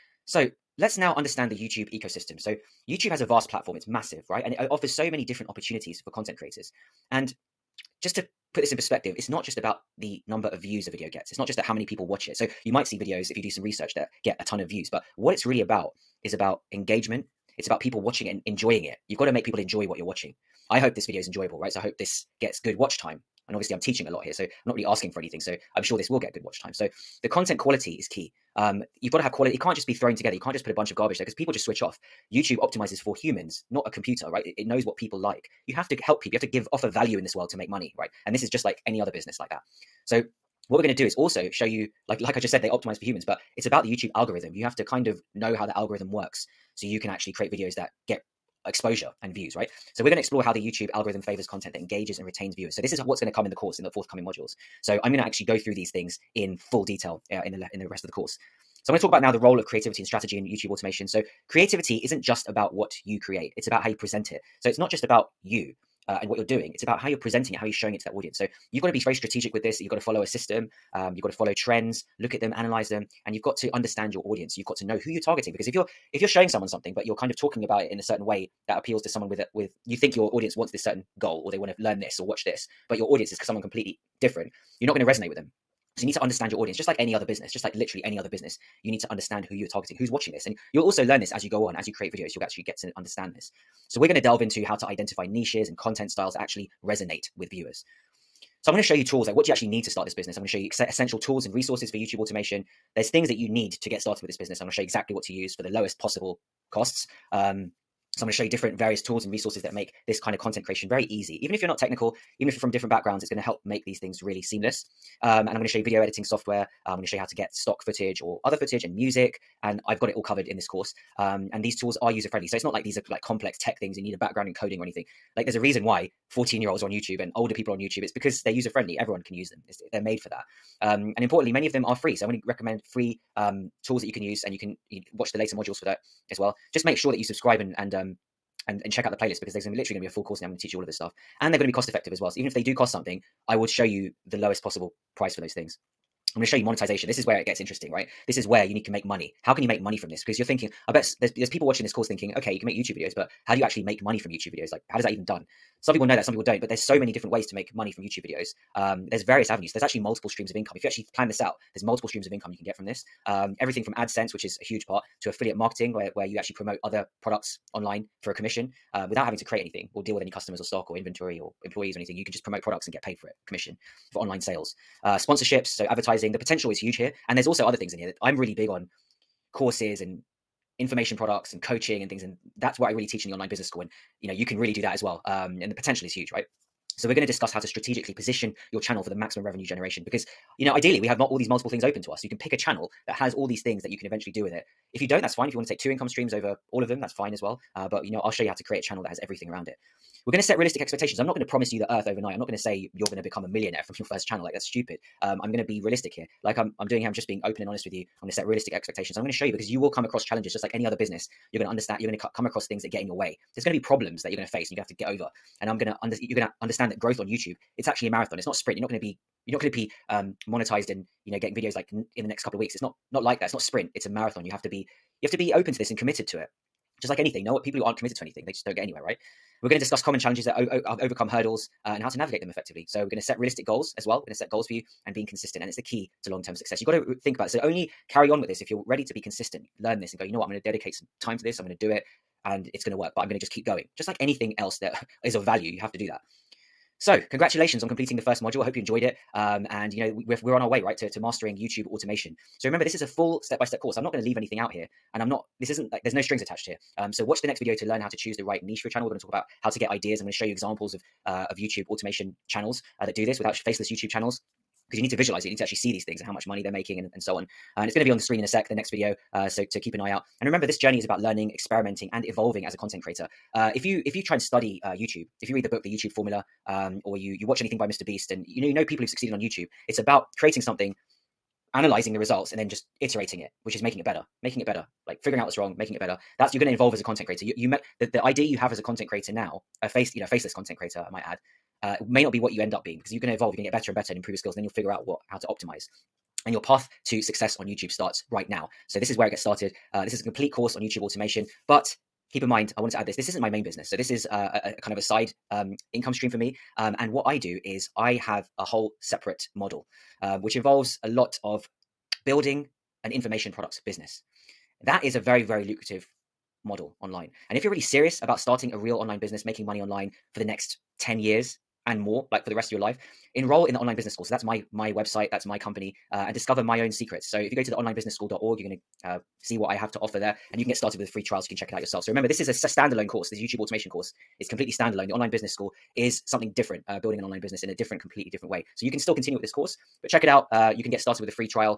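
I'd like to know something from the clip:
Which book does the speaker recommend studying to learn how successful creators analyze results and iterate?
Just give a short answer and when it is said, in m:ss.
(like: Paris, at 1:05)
The YouTube Formula, at 4:35.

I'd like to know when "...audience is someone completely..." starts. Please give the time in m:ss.
1:23.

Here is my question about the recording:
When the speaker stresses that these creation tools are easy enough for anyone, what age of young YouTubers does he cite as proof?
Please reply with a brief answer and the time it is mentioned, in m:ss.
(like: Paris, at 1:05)
14, at 2:06.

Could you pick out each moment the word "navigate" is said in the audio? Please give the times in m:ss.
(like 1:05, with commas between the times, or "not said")
3:52.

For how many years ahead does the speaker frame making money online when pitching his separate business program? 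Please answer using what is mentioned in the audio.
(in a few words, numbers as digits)
10.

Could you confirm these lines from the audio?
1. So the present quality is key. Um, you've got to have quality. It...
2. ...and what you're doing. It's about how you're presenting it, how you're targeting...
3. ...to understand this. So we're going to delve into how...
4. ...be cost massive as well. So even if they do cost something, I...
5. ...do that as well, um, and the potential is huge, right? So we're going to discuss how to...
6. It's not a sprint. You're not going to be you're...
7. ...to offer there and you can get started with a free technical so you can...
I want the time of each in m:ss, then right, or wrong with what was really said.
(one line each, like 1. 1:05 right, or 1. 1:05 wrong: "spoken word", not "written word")
1. 0:26 wrong: "content", not "present"
2. 1:06 wrong: "showing", not "targeting"
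3. 1:32 right
4. 2:21 wrong: "effective", not "massive"
5. 3:04 right
6. 3:38 right
7. 5:29 wrong: "trial", not "technical".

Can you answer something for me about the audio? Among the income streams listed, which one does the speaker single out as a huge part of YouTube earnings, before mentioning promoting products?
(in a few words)
AdSense.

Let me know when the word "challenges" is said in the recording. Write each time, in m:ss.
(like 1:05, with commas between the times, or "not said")
3:30, 3:50.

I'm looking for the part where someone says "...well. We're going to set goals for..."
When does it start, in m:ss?
3:54.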